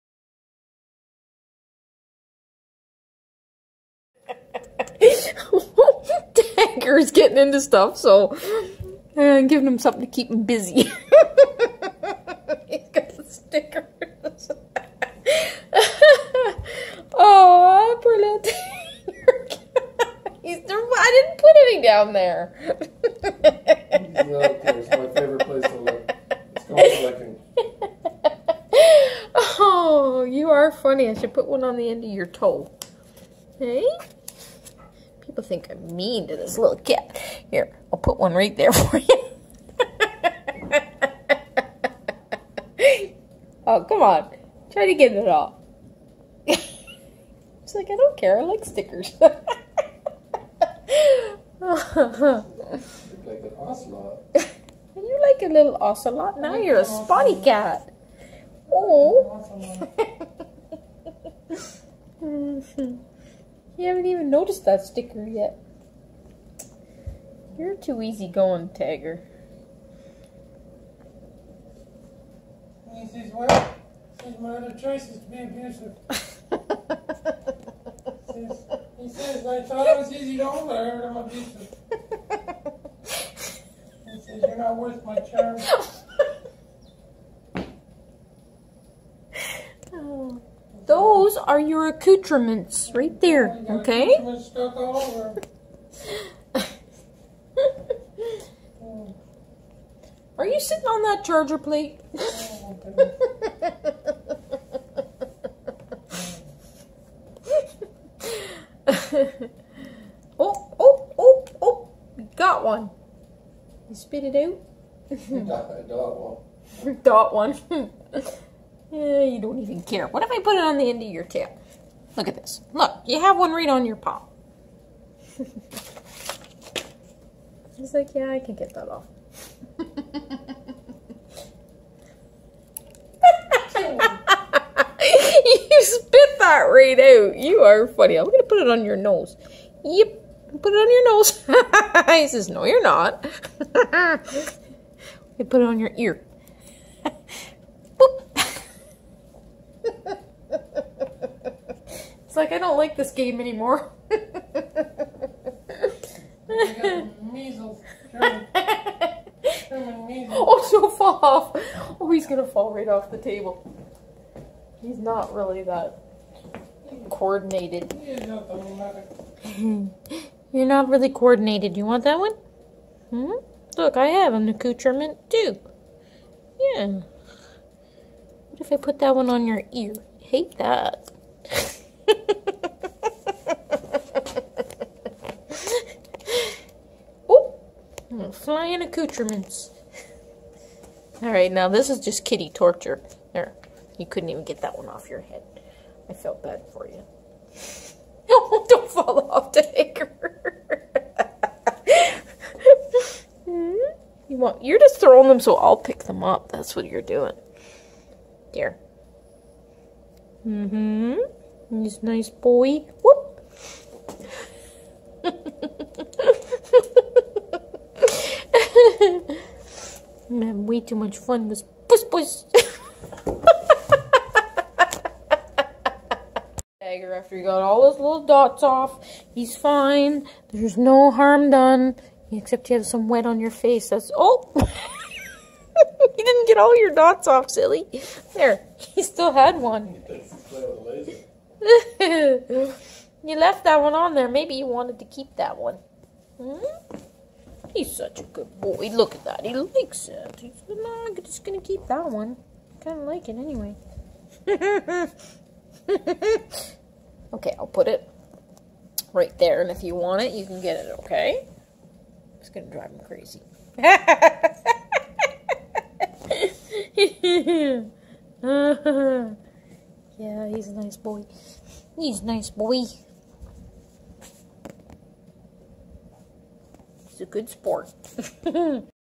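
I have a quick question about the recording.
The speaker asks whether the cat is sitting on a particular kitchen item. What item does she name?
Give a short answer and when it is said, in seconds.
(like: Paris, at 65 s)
charger plate, at 101 s.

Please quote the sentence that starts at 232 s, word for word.
Except you have some wet on your face.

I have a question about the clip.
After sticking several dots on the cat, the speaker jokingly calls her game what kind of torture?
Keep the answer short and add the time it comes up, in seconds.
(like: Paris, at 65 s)
kitty torture, at 192 s.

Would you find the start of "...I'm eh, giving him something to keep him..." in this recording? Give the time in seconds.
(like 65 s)
9 s.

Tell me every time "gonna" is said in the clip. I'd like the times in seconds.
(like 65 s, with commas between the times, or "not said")
251 s, 262 s.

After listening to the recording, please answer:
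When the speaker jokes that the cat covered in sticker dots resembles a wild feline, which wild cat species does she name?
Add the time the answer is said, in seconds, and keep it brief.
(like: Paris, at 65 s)
ocelot, at 55 s.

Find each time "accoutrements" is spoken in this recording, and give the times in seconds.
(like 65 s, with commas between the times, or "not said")
91 s, 174 s, 188 s.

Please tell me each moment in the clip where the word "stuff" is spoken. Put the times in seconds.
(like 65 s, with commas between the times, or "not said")
7 s.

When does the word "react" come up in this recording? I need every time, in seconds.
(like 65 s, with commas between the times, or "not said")
not said.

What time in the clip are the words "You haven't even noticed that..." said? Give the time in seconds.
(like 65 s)
63 s.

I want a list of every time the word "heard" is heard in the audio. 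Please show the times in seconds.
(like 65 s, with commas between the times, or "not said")
80 s.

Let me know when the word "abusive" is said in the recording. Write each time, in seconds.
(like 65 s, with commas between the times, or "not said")
75 s, 81 s.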